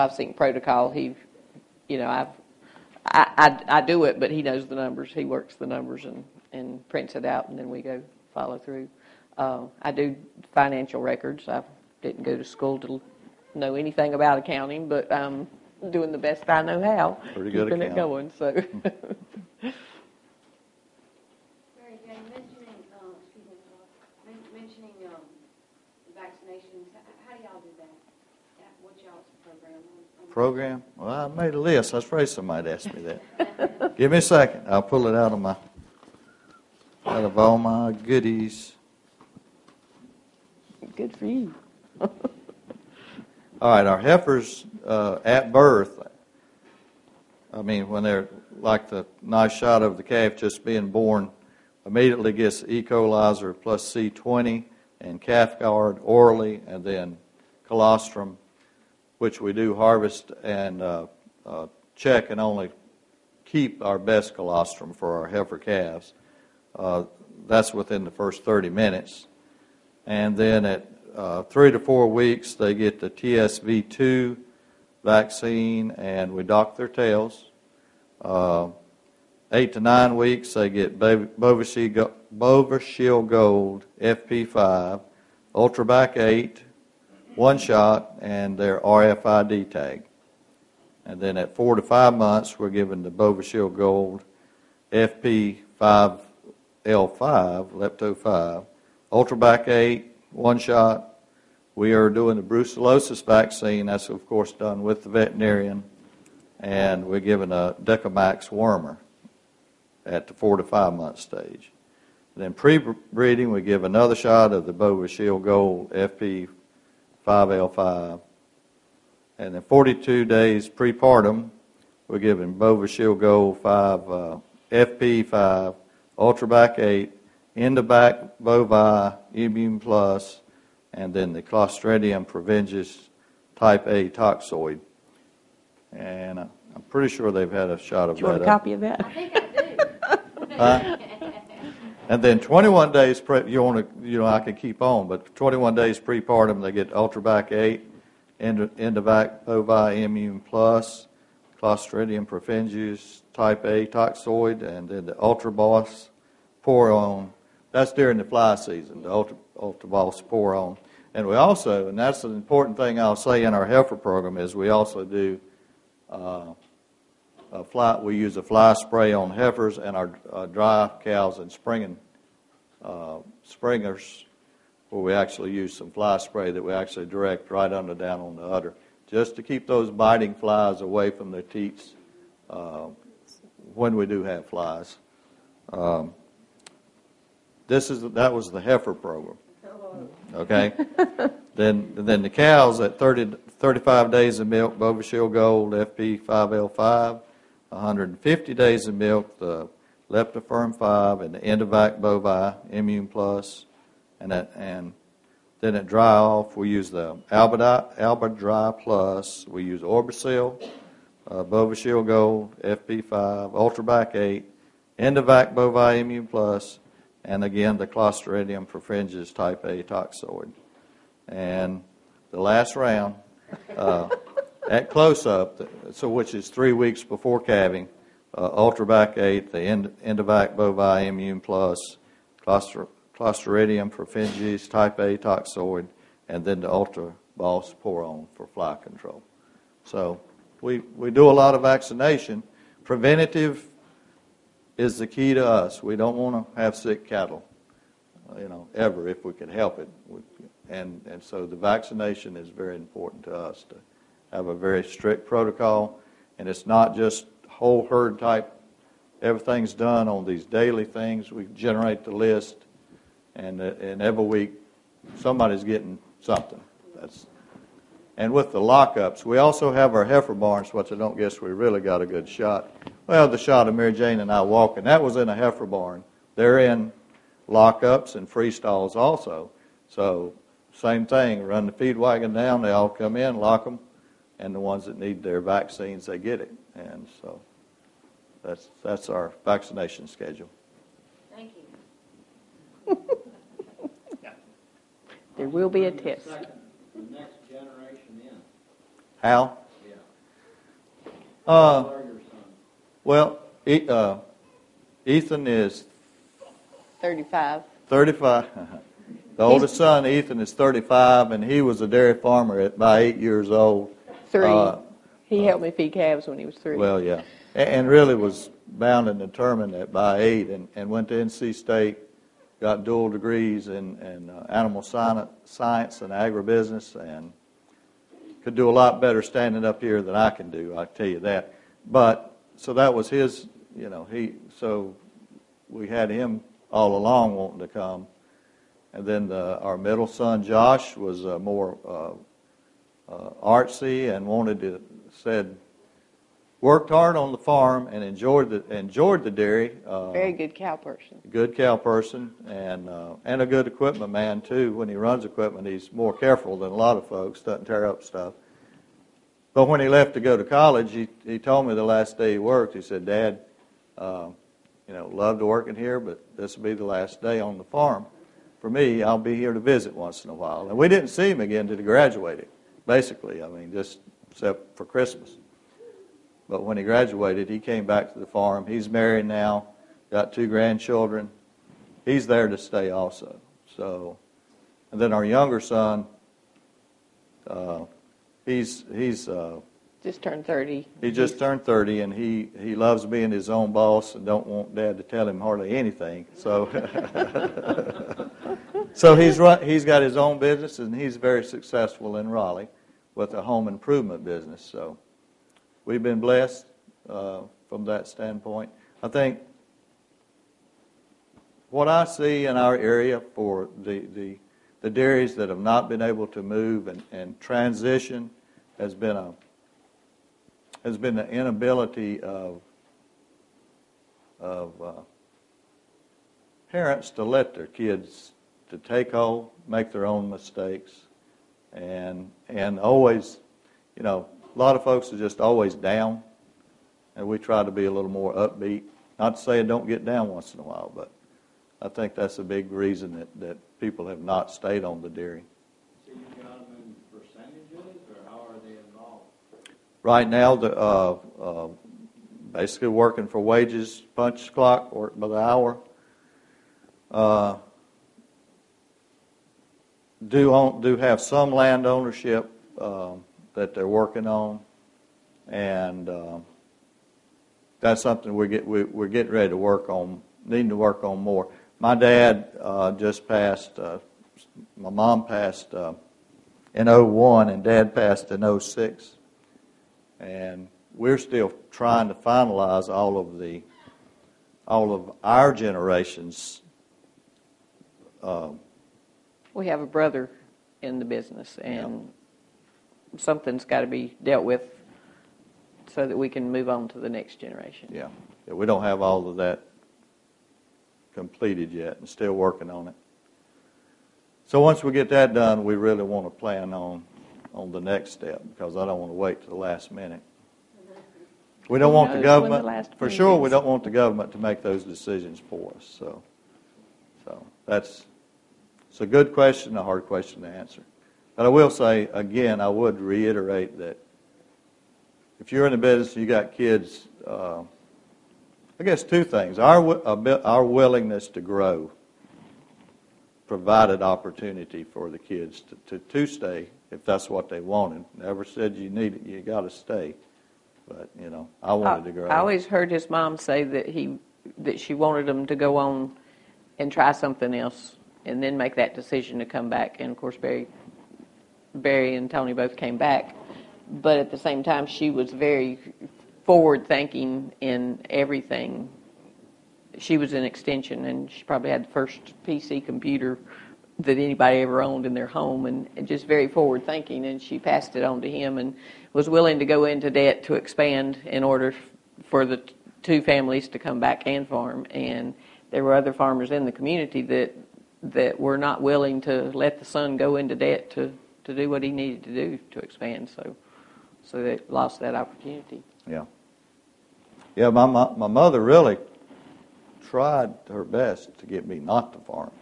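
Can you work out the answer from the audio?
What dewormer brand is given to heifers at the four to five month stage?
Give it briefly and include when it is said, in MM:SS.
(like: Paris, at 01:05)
Dectomax, at 01:47.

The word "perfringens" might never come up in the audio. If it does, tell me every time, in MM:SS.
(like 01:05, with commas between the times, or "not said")
02:12, 02:32, 03:38, 03:53.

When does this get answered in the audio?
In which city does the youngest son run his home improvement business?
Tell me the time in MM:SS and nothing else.
06:42.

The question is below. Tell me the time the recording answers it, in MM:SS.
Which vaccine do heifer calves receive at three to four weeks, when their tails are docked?
01:13.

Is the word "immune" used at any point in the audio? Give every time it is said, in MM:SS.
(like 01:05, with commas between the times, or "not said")
02:09, 02:30, 03:22, 03:35, 03:51.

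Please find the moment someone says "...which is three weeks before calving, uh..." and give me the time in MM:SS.
03:46.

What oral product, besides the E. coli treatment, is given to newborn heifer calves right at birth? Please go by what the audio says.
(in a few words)
Calf Guard.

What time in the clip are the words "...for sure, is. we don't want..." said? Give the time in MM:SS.
08:32.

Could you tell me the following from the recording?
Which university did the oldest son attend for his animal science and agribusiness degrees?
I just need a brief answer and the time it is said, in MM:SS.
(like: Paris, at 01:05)
NC State, at 05:21.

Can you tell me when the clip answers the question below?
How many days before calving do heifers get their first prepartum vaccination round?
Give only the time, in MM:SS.
01:59.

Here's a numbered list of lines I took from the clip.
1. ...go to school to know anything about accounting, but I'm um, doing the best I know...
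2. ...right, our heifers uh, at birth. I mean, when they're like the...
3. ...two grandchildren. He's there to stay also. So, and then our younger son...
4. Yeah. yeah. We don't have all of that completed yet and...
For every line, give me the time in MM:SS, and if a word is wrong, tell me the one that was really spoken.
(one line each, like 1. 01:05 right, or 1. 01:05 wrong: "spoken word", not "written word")
1. 00:12 right
2. 00:43 right
3. 06:20 right
4. 08:17 right.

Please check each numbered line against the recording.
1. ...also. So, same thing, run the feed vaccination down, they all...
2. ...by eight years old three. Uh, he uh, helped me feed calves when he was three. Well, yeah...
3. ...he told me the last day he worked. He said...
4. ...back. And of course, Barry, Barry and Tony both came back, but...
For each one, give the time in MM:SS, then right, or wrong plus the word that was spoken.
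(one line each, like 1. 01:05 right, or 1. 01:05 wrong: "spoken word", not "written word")
1. 04:38 wrong: "wagon", not "vaccination"
2. 05:12 right
3. 06:01 right
4. 09:09 right.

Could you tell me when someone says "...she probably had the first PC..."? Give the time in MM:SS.
09:21.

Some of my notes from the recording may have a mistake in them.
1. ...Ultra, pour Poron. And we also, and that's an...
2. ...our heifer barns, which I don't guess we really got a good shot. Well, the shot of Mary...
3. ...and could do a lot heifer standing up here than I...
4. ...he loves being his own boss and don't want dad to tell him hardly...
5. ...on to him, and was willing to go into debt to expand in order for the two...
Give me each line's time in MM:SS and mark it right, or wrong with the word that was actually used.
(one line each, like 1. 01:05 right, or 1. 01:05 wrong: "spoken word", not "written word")
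1. 02:39 right
2. 04:29 right
3. 05:26 wrong: "better", not "heifer"
4. 06:32 right
5. 09:28 right.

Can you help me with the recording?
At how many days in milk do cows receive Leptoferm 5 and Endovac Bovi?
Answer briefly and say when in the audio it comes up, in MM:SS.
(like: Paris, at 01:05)
150 days, at 03:17.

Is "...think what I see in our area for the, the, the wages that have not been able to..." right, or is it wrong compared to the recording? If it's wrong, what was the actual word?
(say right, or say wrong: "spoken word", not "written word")
wrong: "dairies", not "wages".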